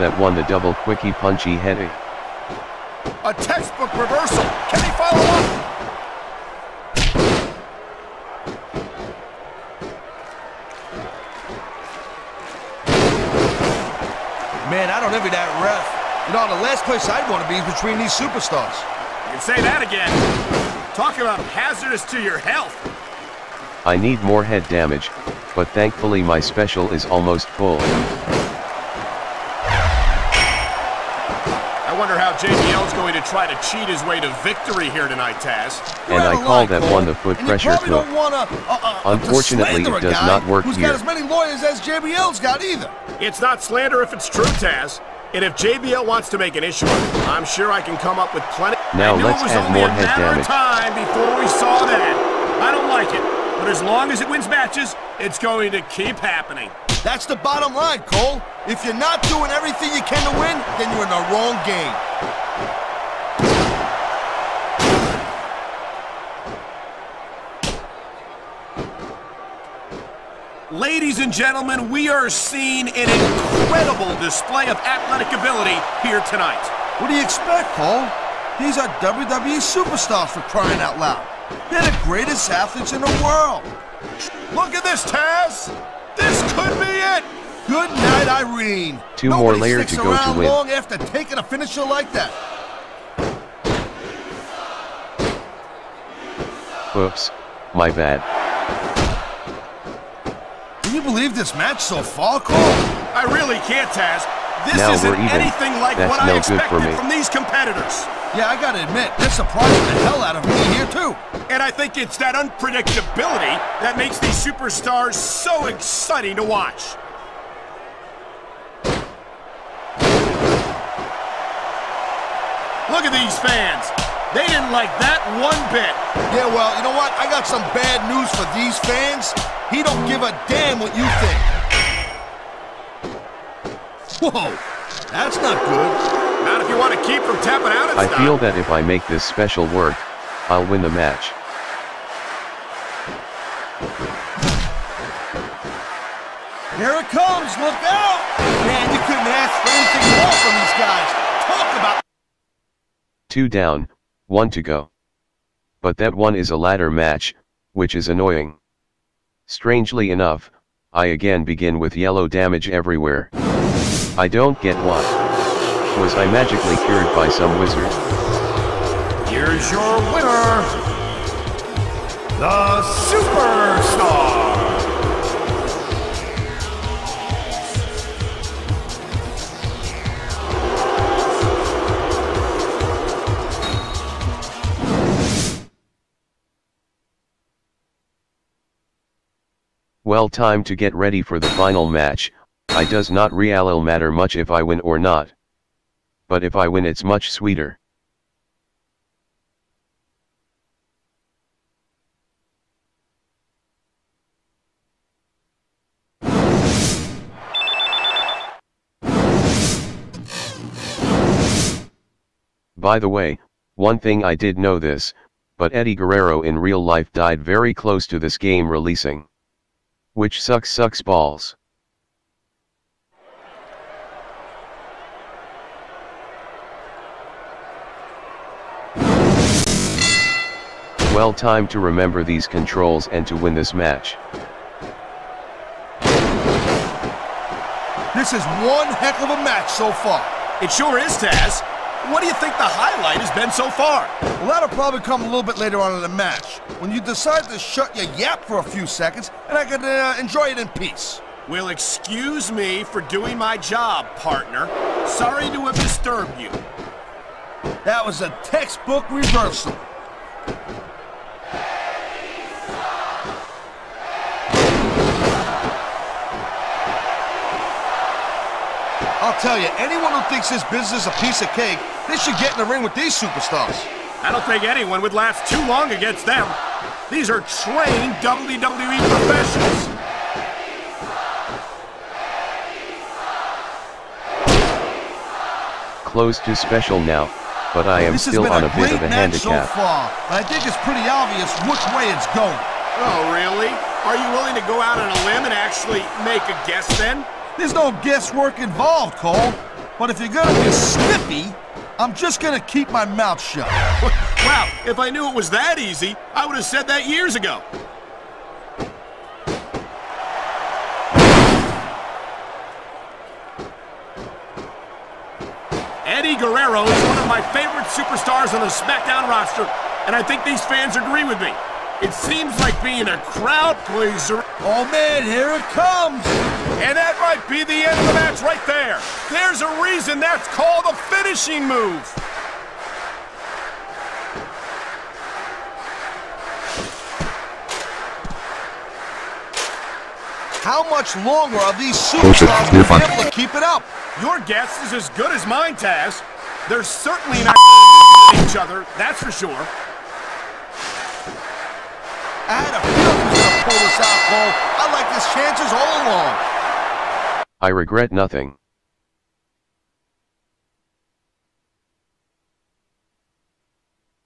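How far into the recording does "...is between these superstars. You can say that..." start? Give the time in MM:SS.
00:17.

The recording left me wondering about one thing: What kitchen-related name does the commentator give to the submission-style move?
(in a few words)
foot pressure cook.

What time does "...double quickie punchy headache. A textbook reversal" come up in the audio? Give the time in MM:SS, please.
00:00.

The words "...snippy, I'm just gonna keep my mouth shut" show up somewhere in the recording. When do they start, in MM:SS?
05:00.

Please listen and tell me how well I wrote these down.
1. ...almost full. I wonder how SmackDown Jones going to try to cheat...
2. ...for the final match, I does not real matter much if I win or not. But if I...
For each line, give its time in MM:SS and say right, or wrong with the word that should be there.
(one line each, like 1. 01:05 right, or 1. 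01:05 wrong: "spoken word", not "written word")
1. 00:27 wrong: "JBL", not "SmackDown"
2. 03:11 right.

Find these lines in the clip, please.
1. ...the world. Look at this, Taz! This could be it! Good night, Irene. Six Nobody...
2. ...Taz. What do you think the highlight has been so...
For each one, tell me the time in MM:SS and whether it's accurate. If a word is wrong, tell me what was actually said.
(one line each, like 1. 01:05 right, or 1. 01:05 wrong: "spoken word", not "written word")
1. 01:22 wrong: "Two", not "Six"
2. 04:01 right.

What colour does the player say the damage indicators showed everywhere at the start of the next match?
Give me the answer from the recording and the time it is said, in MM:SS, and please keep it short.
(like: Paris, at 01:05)
yellow, at 02:41.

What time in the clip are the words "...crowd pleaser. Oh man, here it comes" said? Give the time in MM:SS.
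05:23.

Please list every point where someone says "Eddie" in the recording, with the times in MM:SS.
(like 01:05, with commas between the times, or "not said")
03:35, 05:16.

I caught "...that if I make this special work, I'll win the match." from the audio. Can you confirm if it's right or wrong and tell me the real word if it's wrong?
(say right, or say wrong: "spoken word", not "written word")
right.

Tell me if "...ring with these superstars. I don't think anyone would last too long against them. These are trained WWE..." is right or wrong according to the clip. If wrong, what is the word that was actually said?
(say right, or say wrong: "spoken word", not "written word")
right.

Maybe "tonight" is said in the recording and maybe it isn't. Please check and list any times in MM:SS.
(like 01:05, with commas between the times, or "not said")
00:35, 01:16.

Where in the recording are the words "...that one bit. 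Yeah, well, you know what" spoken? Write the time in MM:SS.
02:04.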